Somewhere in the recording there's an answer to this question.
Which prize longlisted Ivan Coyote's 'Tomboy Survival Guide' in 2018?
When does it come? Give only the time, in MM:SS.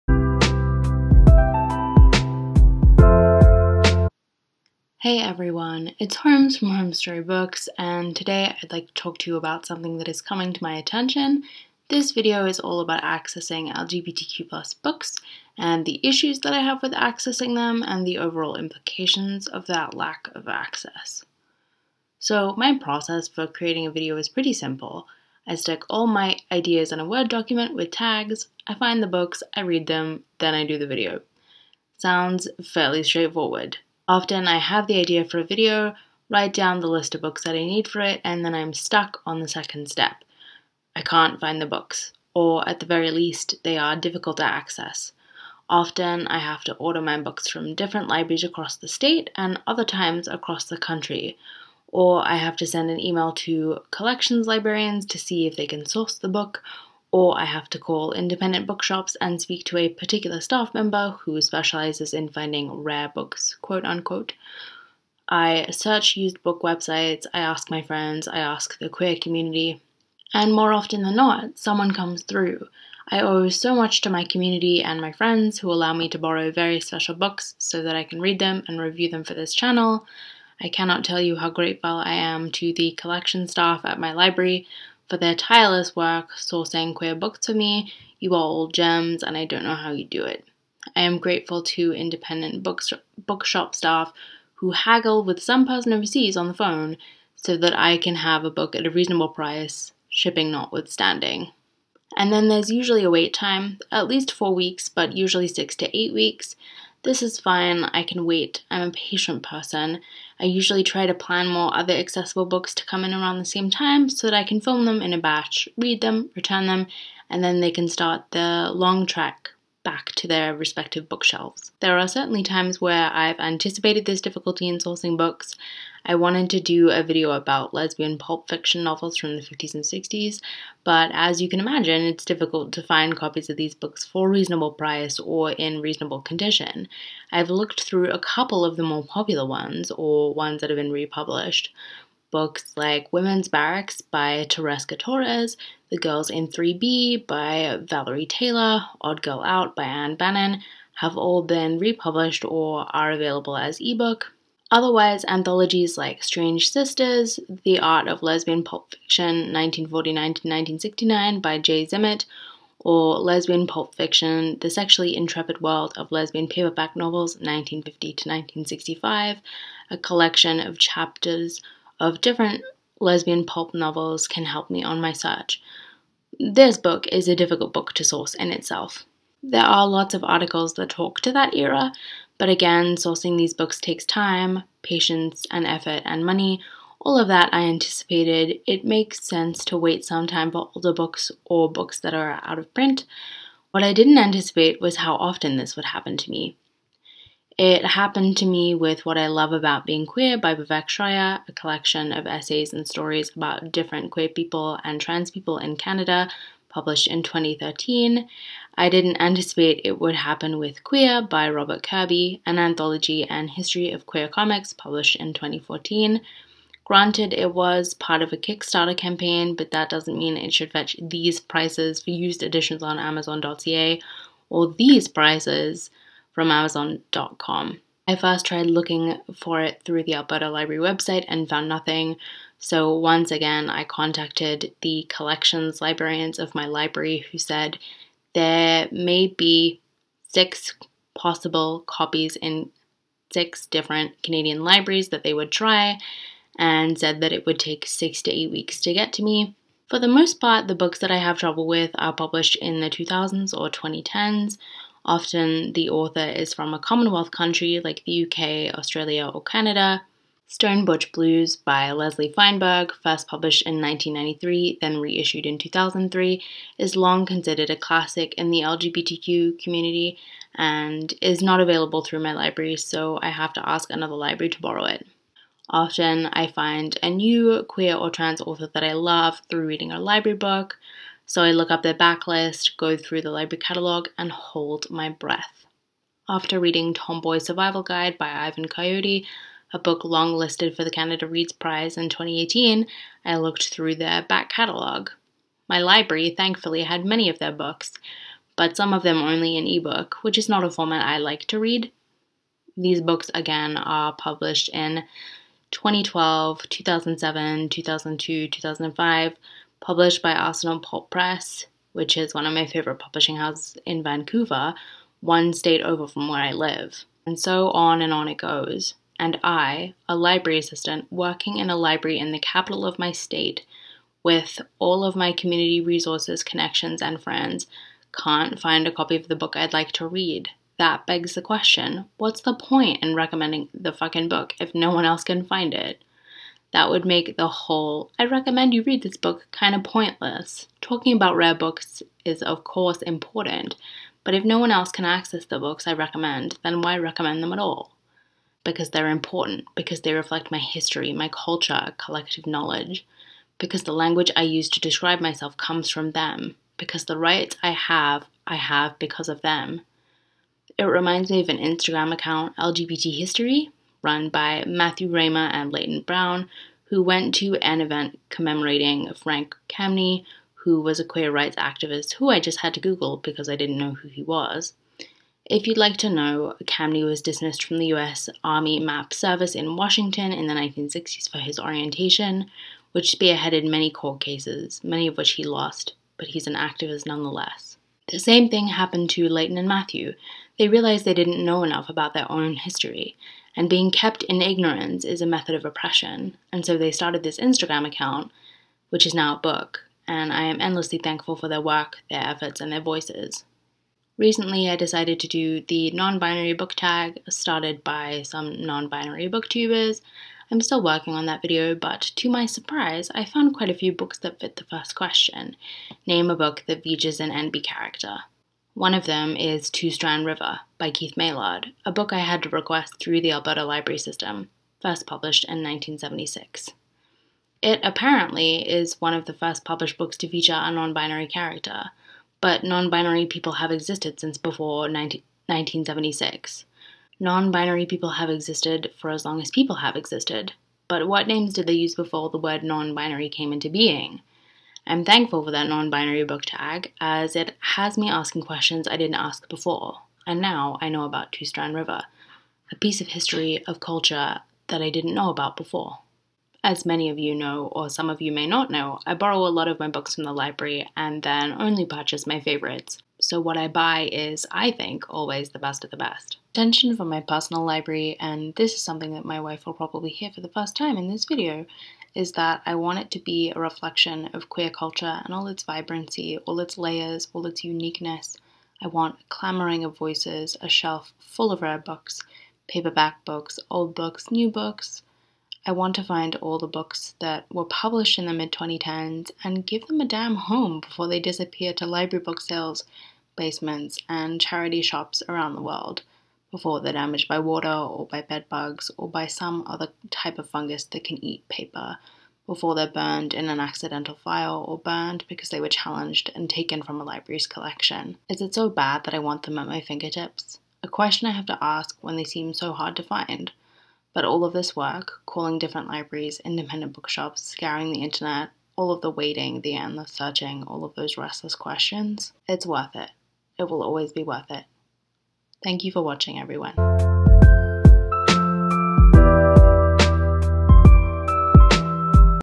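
04:50.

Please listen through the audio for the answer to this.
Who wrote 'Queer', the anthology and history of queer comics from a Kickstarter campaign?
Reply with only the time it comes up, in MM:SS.
03:31.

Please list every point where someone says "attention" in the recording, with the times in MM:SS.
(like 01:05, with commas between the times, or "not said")
00:10, 07:46.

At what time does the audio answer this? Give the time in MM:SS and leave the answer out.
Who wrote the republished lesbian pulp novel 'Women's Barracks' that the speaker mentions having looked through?
02:24.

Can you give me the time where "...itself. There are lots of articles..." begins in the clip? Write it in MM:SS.
02:58.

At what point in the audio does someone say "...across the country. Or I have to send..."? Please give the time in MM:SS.
00:50.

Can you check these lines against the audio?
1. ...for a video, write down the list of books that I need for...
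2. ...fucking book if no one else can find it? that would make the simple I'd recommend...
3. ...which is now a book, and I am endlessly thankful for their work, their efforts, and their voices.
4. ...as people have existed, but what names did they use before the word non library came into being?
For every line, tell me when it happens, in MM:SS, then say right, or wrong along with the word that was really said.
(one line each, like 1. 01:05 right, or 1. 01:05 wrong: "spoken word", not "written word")
1. 00:35 right
2. 05:33 wrong: "whole", not "simple"
3. 06:38 right
4. 07:19 wrong: "binary", not "library".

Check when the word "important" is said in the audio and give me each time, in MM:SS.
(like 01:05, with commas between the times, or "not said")
05:43, 05:49.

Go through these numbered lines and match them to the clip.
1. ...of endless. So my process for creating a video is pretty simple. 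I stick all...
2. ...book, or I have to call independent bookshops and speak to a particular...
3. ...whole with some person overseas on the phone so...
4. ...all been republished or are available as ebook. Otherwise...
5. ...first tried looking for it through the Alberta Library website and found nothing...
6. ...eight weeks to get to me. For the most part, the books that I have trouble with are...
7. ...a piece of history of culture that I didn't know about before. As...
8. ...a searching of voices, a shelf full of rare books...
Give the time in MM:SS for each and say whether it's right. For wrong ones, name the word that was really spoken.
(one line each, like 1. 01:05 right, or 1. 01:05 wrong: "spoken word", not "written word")
1. 00:20 wrong: "access", not "endless"
2. 00:56 right
3. 01:34 wrong: "haggle", not "whole"
4. 02:31 right
5. 03:48 right
6. 04:08 right
7. 07:32 right
8. 07:59 wrong: "clamoring", not "searching".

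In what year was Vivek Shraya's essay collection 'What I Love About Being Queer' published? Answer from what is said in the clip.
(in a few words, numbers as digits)
2013.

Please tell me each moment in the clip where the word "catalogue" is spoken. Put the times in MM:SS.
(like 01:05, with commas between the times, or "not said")
04:43, 04:54.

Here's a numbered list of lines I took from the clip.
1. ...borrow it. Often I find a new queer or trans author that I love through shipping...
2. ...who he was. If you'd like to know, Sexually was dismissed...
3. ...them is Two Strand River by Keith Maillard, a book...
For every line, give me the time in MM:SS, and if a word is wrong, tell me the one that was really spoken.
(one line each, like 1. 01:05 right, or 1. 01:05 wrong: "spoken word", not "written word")
1. 04:34 wrong: "reading", not "shipping"
2. 06:13 wrong: "Camney", not "Sexually"
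3. 06:59 right.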